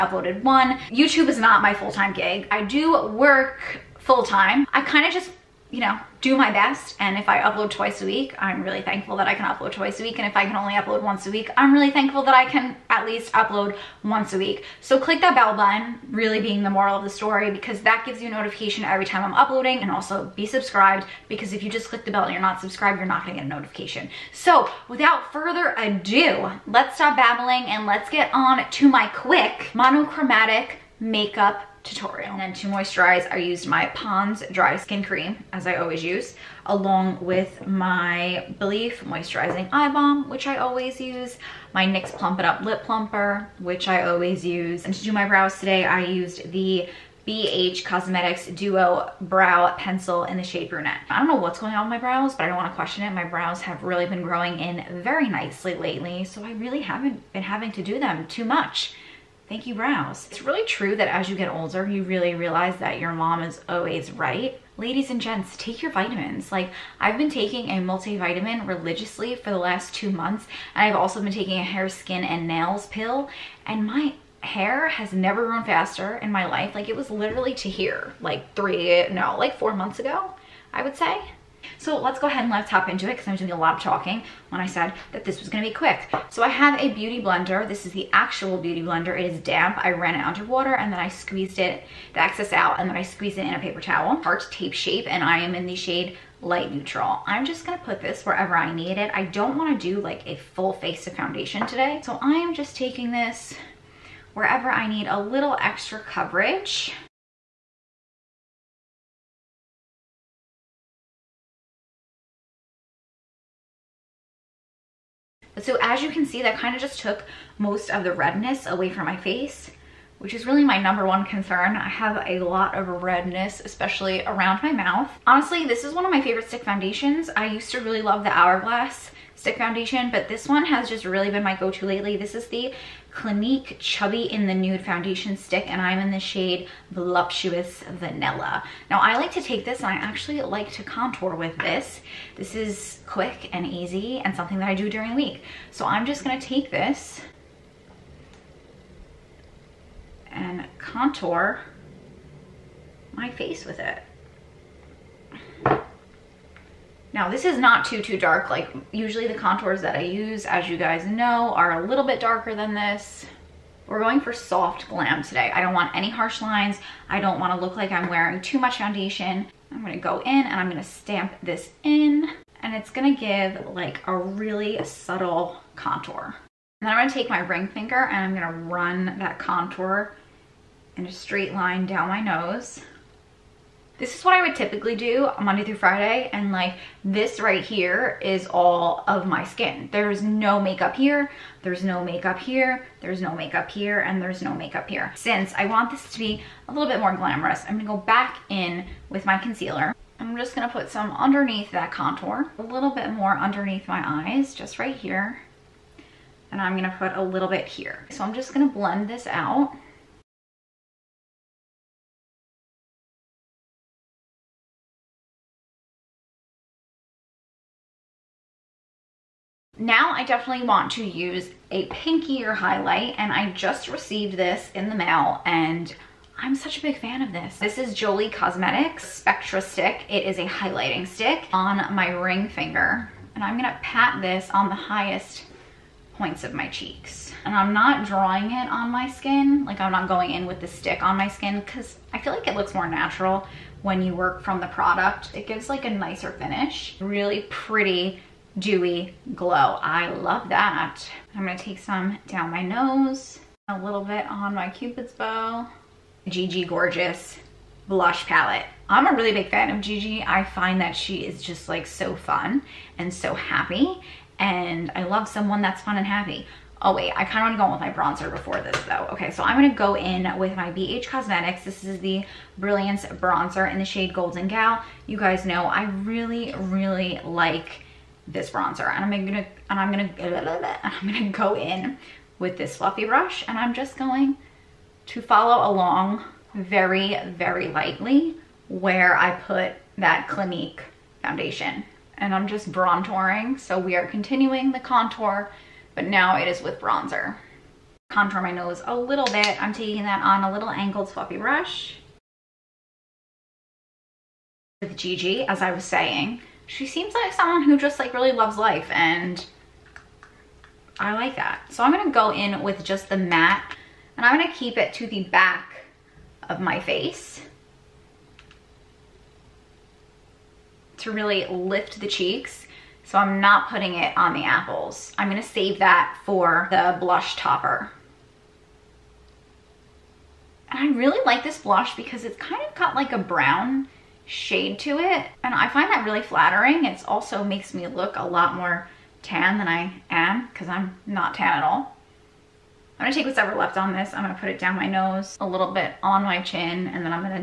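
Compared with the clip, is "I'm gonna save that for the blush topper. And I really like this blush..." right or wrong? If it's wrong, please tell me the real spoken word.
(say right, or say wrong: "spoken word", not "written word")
right.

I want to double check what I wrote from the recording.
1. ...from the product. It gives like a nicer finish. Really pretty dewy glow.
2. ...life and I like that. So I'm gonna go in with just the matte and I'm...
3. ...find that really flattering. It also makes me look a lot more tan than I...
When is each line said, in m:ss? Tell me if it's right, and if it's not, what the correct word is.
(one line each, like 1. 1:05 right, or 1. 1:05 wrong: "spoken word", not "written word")
1. 4:04 right
2. 5:08 right
3. 5:35 right.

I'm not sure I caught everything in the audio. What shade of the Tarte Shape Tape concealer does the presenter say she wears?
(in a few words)
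Light neutral.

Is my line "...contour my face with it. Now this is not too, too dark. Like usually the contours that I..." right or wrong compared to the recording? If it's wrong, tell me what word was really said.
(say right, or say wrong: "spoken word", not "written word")
right.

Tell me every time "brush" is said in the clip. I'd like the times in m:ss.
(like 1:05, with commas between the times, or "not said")
4:43, 5:01.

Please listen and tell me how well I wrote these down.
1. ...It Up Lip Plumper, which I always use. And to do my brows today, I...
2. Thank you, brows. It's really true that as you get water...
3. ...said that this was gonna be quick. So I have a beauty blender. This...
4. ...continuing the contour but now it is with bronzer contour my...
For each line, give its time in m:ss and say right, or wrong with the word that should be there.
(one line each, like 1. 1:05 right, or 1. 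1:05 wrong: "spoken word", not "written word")
1. 0:42 right
2. 0:59 wrong: "older", not "water"
3. 1:24 right
4. 4:54 right.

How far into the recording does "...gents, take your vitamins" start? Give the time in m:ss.
1:05.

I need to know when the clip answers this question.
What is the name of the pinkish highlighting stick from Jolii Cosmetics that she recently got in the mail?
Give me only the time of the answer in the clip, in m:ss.
3:49.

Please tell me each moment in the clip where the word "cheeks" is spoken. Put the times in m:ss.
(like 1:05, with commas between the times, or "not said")
3:56, 5:22.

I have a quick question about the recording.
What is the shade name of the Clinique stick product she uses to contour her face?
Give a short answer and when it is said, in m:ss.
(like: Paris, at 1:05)
Voluptuous Vanilla, at 2:16.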